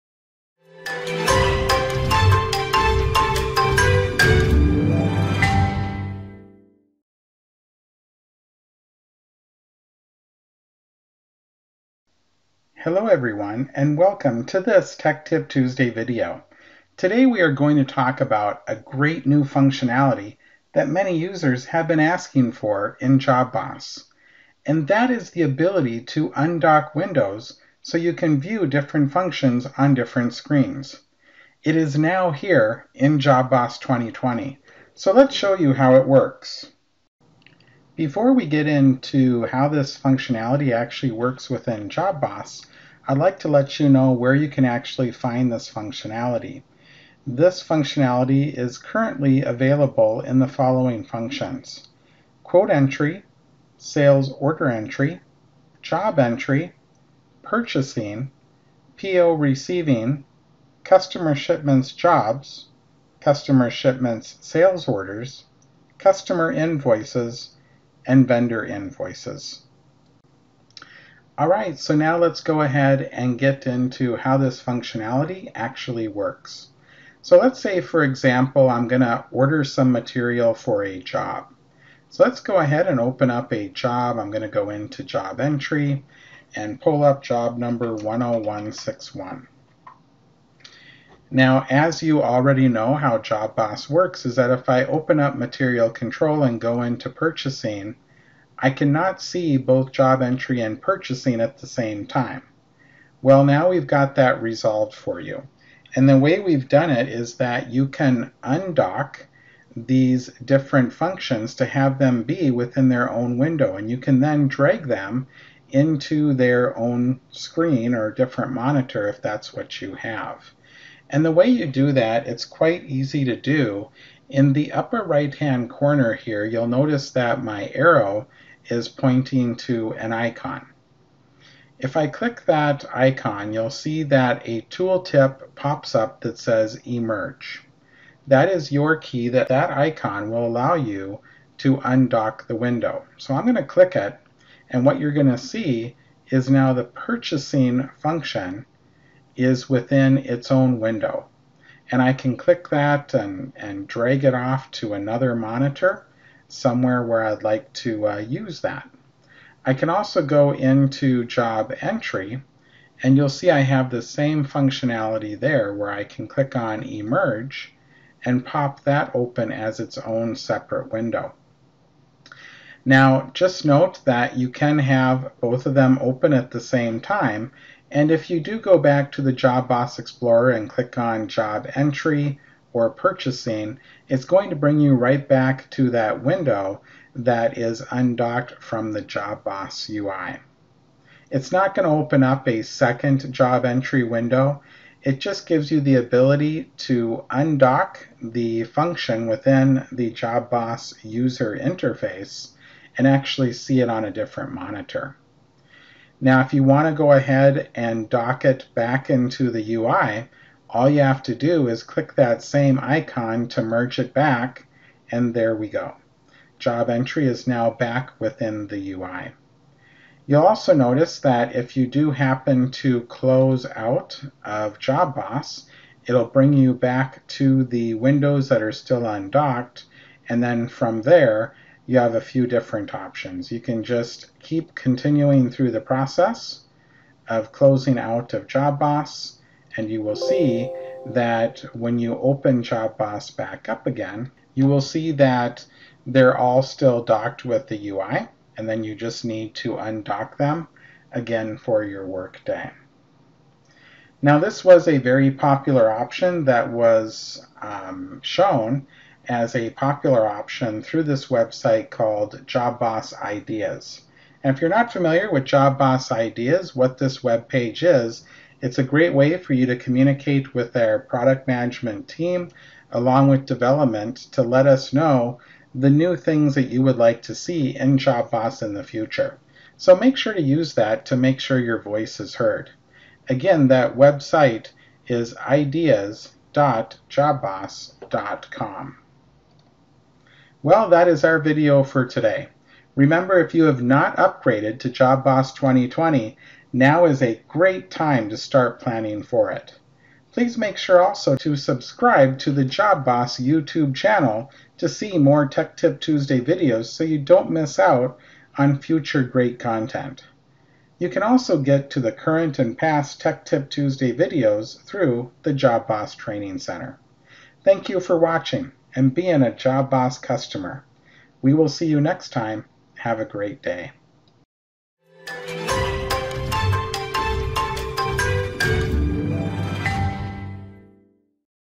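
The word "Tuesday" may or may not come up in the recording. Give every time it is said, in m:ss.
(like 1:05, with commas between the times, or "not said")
0:15, 5:05, 5:13.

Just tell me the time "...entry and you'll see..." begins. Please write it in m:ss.
2:41.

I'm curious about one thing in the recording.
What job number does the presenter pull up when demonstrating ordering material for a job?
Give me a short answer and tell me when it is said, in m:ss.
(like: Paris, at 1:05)
10161, at 1:27.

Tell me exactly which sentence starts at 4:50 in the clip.
Well, that is our video for today.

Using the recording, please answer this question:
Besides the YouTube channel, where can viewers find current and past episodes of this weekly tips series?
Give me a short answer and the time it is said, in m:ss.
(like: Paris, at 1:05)
Job Boss Training Center, at 5:15.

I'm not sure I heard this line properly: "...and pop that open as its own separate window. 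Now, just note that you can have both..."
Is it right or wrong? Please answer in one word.
right.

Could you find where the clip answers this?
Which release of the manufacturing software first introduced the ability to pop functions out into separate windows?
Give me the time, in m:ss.
0:33.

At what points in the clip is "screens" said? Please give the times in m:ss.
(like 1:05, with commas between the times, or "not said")
0:30, 1:57.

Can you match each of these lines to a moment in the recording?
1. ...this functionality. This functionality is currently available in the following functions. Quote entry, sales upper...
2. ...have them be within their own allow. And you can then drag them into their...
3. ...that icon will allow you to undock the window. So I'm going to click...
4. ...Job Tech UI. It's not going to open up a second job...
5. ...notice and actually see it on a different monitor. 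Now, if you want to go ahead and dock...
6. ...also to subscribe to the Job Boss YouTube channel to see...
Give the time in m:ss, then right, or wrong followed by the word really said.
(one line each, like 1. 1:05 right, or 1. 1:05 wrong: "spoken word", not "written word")
1. 0:45 wrong: "order", not "upper"
2. 1:51 wrong: "window", not "allow"
3. 2:19 right
4. 3:09 wrong: "Boss", not "Tech"
5. 3:21 wrong: "interface", not "notice"
6. 5:01 right.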